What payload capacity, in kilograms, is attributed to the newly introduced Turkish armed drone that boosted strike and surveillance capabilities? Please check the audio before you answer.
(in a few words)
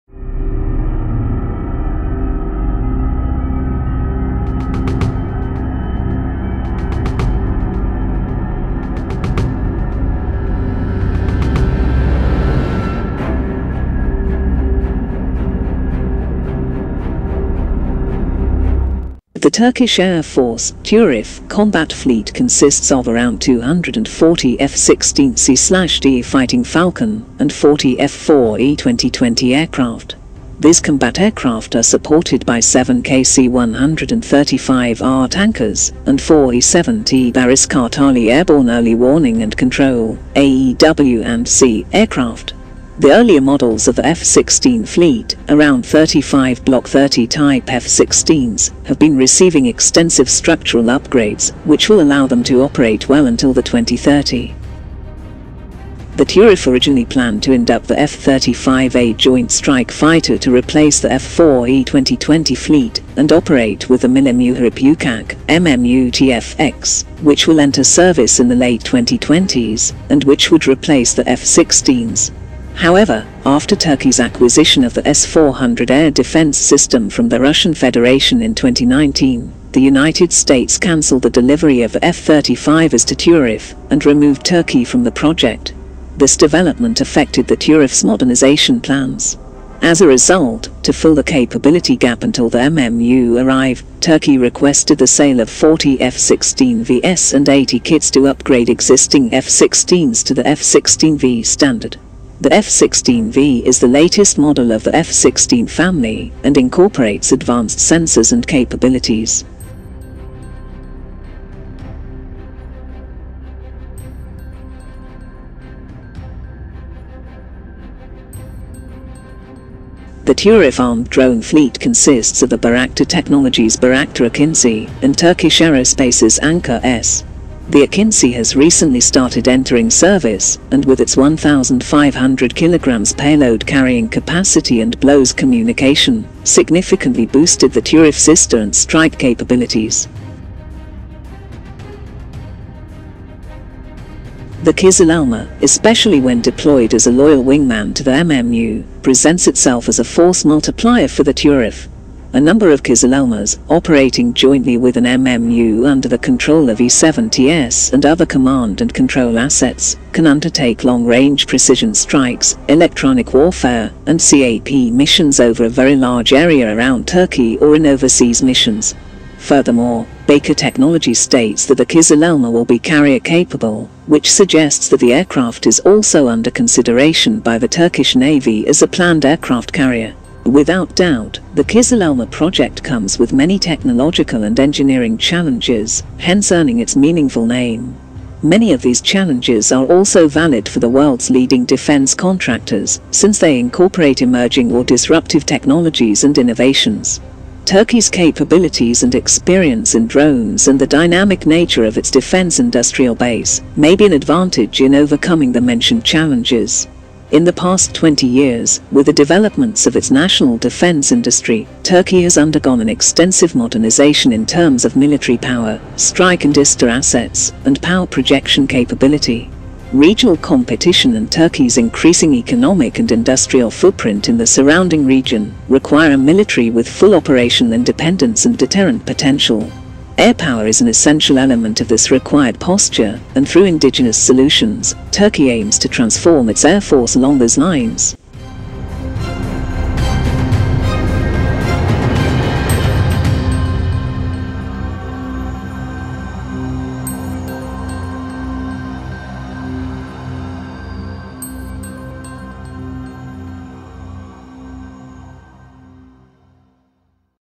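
1,500 kilograms.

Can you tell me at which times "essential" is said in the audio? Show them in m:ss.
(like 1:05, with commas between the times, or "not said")
3:50.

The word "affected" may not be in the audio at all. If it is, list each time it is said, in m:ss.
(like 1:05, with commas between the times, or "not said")
1:27.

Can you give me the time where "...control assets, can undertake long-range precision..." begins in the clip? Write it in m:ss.
2:38.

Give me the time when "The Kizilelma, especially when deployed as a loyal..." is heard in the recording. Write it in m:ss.
2:24.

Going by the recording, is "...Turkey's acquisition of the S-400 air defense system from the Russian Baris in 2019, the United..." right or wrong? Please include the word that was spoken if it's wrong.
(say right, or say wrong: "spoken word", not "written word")
wrong: "Federation", not "Baris".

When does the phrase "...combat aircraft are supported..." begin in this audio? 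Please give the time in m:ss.
0:30.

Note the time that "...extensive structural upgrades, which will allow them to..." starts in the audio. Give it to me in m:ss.
0:49.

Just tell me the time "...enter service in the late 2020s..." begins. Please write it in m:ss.
1:07.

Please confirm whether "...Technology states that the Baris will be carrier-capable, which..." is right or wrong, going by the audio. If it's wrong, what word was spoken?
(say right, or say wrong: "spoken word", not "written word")
wrong: "Kizilelma", not "Baris".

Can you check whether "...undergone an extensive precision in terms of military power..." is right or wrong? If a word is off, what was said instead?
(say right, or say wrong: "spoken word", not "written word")
wrong: "modernization", not "precision".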